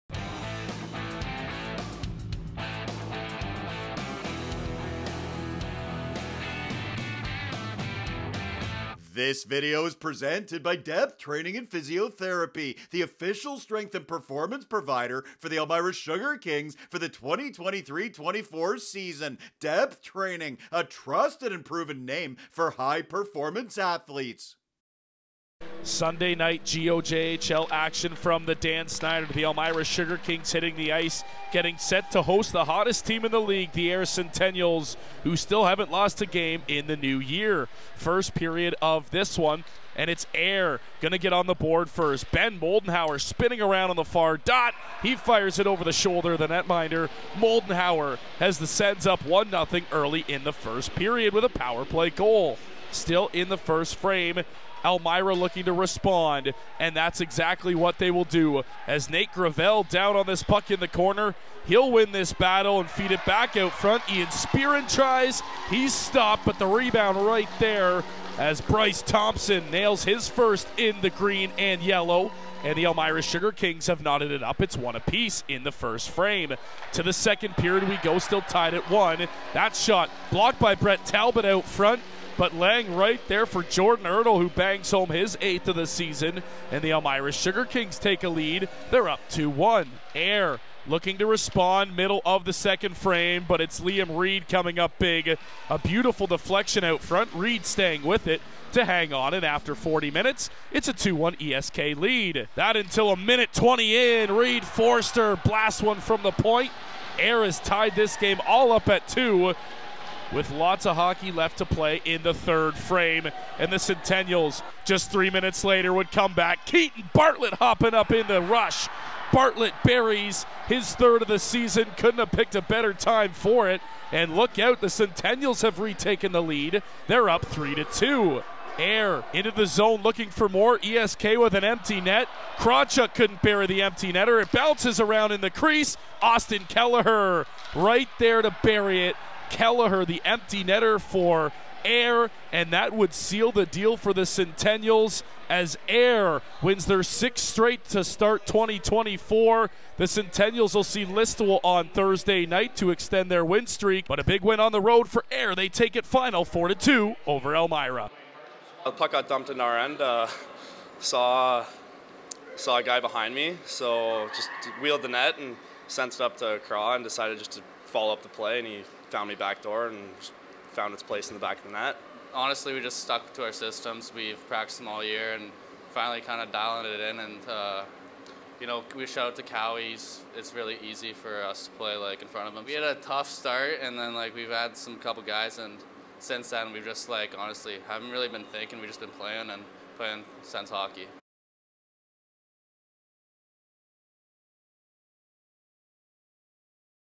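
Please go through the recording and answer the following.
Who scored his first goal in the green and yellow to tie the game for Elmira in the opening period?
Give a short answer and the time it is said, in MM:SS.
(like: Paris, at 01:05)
Bryce Thompson, at 01:08.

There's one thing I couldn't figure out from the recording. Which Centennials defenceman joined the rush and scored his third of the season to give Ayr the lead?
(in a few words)
Keaton Bartlett.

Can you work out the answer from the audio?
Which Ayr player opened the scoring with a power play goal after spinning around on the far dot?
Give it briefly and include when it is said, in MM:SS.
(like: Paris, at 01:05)
Ben Moldenhauer, at 00:42.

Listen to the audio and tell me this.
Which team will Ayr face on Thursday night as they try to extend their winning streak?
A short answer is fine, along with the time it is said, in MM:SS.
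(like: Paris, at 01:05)
Listowel, at 02:31.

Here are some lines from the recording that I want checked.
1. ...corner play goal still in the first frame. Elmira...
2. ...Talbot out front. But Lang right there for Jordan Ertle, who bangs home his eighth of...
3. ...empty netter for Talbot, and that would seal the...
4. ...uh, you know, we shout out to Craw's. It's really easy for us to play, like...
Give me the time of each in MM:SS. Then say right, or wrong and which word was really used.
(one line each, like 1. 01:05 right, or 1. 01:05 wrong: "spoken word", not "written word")
1. 00:51 wrong: "power", not "corner"
2. 01:21 right
3. 02:20 wrong: "Ayr", not "Talbot"
4. 02:57 wrong: "Cowie", not "Craw".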